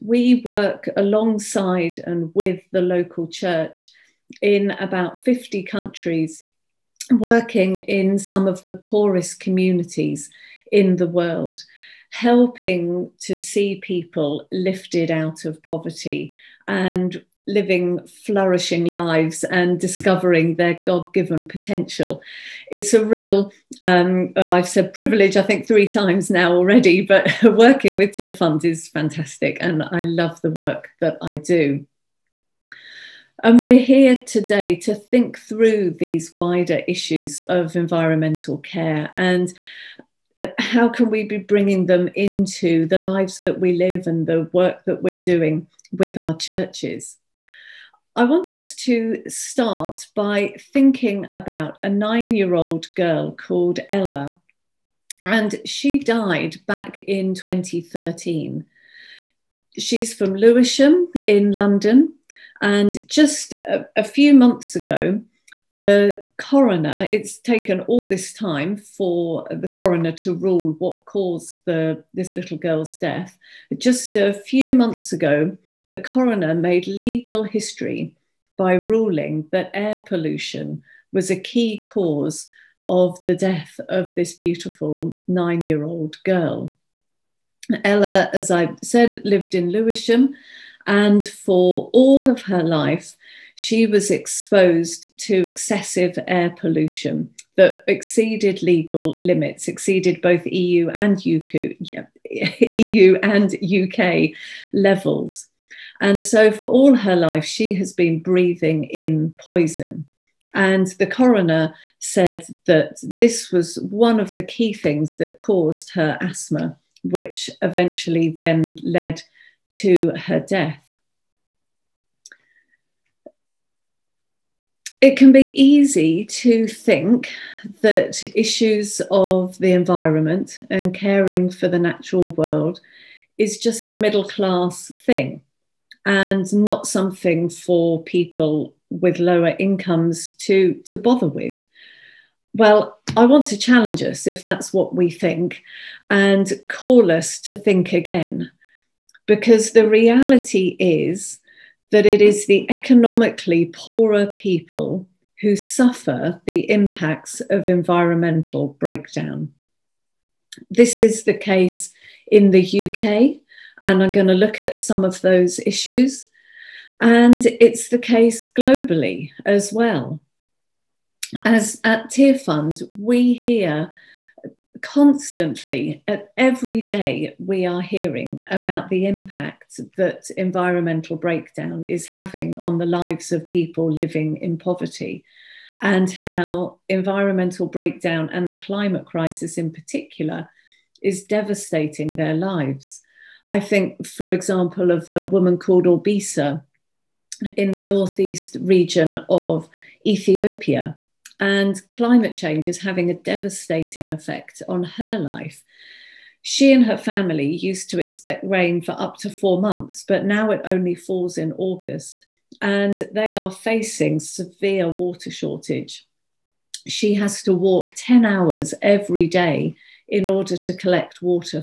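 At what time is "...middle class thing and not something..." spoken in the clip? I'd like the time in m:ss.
2:13.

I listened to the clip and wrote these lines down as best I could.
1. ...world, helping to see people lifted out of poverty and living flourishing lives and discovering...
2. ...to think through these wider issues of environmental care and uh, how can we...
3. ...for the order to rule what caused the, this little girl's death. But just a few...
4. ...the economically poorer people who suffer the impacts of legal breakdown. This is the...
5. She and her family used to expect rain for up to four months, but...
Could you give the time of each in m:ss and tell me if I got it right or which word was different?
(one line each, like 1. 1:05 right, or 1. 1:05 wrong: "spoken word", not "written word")
1. 0:11 right
2. 0:34 right
3. 1:08 wrong: "coroner", not "order"
4. 2:32 wrong: "environmental", not "legal"
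5. 3:26 right.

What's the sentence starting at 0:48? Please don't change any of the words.
I want us to start by thinking about a nine year old girl called Ella.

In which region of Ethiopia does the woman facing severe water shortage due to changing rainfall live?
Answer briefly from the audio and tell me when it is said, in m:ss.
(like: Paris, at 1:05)
Northeast, at 3:17.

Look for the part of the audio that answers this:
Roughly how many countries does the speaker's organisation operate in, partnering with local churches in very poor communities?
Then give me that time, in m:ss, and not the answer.
0:04.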